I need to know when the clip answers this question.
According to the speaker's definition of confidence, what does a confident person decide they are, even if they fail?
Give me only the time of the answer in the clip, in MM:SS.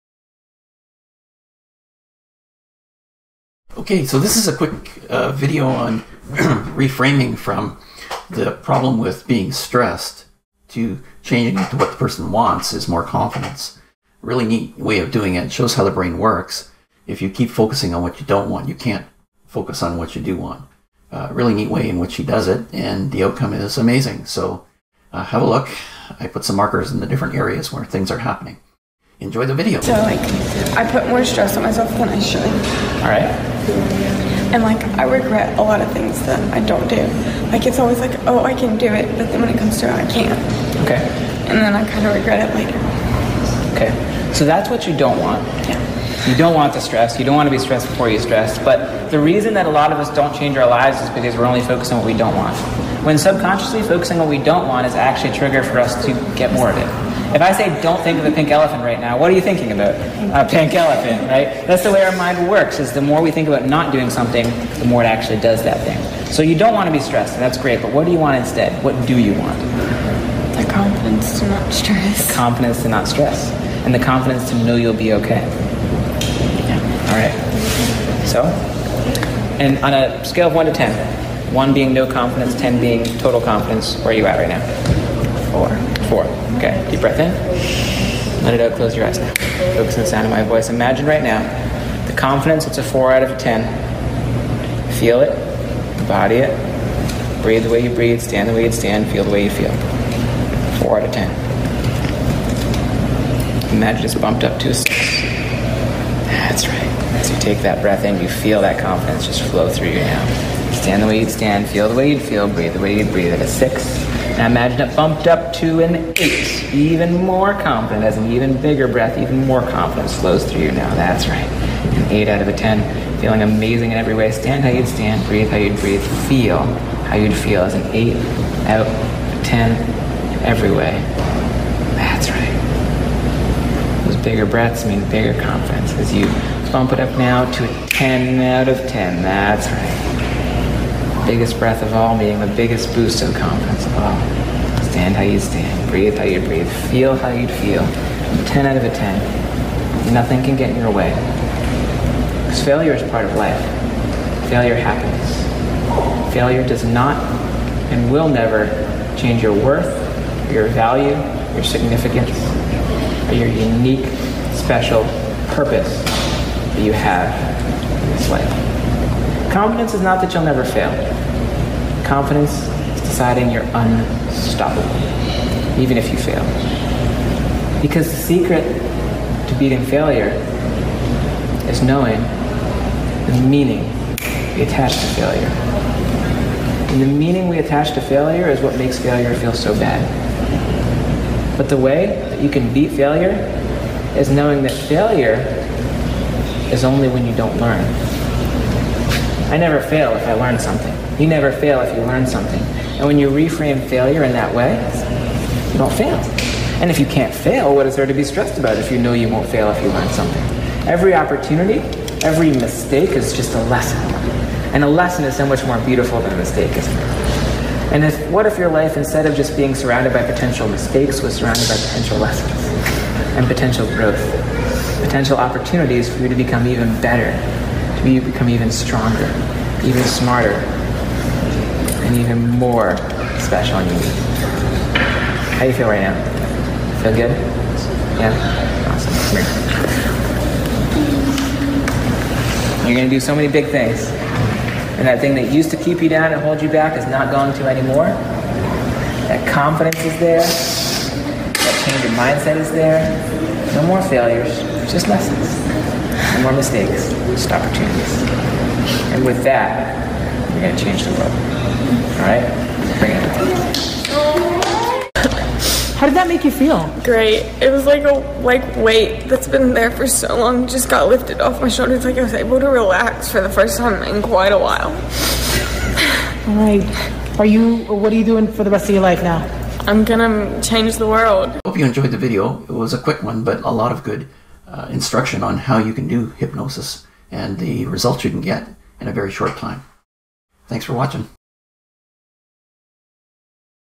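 02:53.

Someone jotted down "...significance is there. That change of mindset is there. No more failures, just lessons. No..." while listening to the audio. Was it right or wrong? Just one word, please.
wrong.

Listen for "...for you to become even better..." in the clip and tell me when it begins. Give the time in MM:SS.
03:46.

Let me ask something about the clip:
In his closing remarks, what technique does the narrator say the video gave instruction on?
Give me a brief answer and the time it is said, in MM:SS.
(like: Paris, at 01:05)
hypnosis, at 04:46.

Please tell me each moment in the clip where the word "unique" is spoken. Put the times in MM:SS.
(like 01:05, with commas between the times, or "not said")
02:43, 03:53.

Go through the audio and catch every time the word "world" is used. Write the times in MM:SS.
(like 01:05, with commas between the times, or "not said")
04:21, 04:41.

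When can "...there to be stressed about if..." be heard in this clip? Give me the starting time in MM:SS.
03:27.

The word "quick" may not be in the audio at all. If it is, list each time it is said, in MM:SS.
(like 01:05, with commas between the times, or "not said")
00:04, 04:42.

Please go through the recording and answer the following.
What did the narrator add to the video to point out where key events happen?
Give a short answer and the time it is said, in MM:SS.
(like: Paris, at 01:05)
markers, at 00:26.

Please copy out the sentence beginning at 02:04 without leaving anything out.
Stand how you'd stand, breathe how you'd breathe, feel how you'd feel as an eight out of ten every way.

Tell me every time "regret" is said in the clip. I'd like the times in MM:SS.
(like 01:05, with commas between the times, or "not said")
00:35, 00:42.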